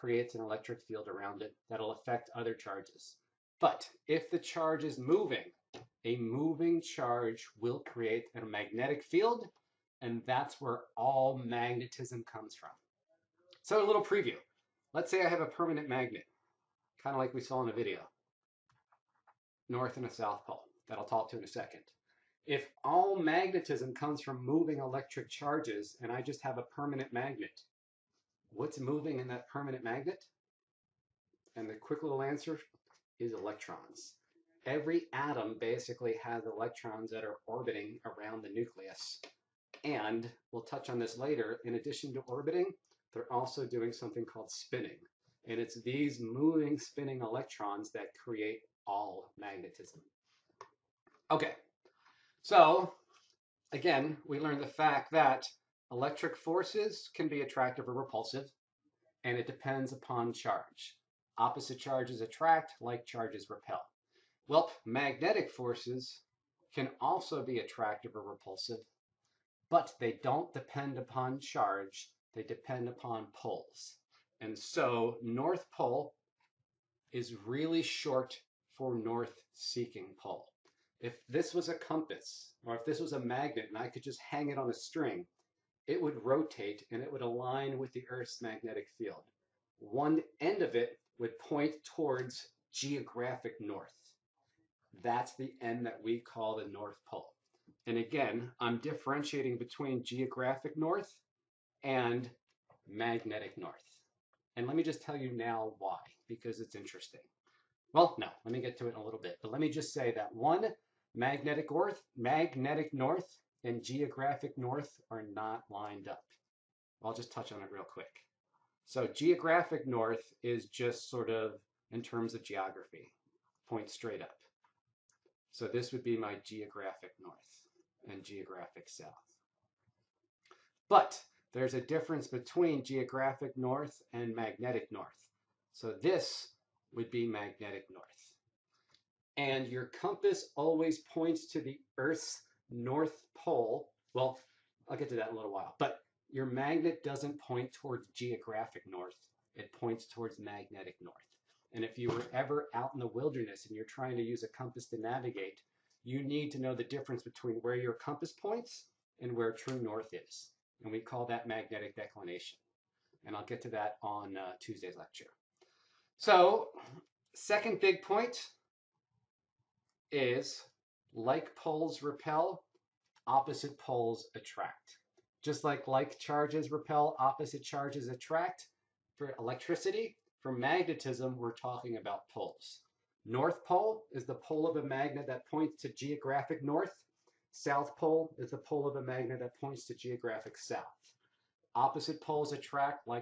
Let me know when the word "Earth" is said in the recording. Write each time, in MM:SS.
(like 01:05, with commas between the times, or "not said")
01:28, 02:21.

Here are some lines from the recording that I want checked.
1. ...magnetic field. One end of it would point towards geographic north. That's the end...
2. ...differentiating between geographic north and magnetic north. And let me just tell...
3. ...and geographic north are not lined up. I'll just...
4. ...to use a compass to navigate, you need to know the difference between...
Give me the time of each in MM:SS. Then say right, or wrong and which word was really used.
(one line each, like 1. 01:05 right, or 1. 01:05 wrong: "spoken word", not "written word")
1. 01:28 right
2. 01:38 right
3. 01:53 right
4. 02:34 right.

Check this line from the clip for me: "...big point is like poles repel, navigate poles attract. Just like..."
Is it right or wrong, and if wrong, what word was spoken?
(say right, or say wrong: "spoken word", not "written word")
wrong: "opposite", not "navigate".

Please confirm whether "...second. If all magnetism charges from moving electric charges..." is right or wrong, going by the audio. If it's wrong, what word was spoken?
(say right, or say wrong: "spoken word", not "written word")
wrong: "comes", not "charges".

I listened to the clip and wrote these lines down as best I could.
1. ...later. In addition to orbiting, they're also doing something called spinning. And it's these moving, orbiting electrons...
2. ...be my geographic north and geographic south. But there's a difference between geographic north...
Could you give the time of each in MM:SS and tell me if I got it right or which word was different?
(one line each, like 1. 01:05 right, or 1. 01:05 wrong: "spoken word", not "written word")
1. 00:41 wrong: "spinning", not "orbiting"
2. 02:06 right.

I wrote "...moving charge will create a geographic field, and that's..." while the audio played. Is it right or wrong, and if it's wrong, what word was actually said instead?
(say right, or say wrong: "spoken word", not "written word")
wrong: "magnetic", not "geographic".